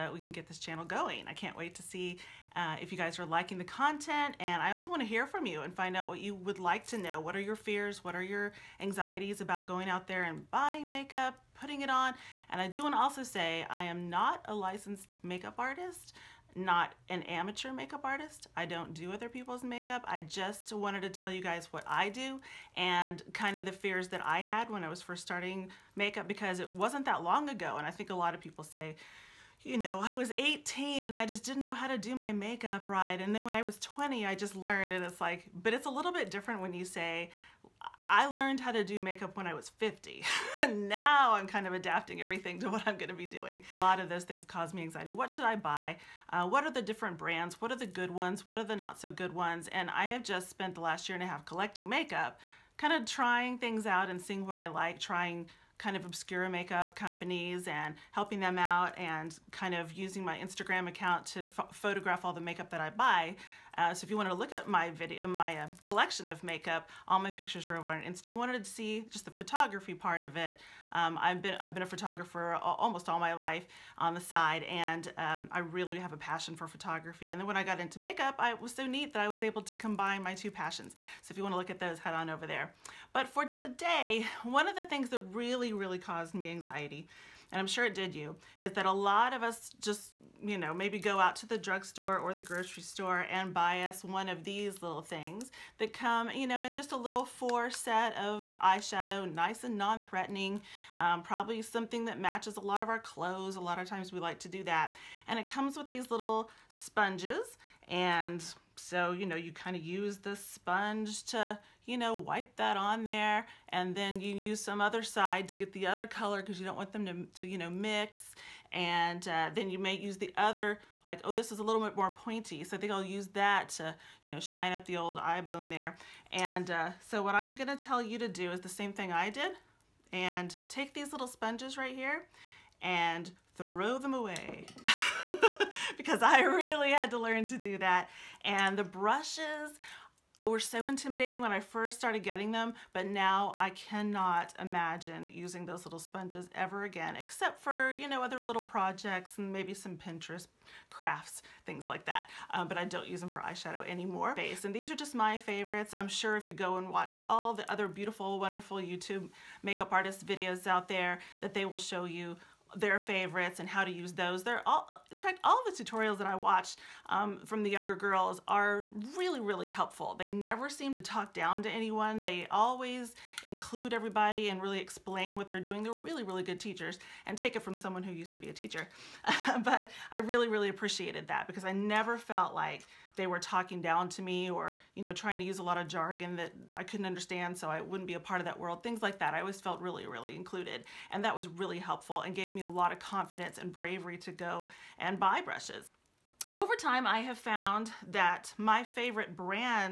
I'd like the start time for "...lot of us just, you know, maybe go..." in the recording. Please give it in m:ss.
1:28.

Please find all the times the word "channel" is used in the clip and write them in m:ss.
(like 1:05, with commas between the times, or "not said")
0:00.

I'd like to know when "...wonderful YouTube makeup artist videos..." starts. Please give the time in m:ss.
2:38.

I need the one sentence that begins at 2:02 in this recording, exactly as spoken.
So I think I'll use that to, you know, shine up the old eye bone there.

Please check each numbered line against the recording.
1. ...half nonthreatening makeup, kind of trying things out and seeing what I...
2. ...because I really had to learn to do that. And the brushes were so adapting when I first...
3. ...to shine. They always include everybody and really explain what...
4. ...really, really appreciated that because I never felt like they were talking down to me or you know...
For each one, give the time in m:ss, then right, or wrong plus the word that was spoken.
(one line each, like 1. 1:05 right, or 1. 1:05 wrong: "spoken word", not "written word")
1. 0:51 wrong: "collecting", not "nonthreatening"
2. 2:15 wrong: "intimidating", not "adapting"
3. 2:51 wrong: "anyone", not "shine"
4. 3:00 right.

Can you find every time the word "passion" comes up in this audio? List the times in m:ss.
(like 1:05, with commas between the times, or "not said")
1:16, 1:20.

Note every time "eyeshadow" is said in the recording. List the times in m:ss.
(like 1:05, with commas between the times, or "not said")
1:38, 2:33.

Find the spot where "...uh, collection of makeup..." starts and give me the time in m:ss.
1:05.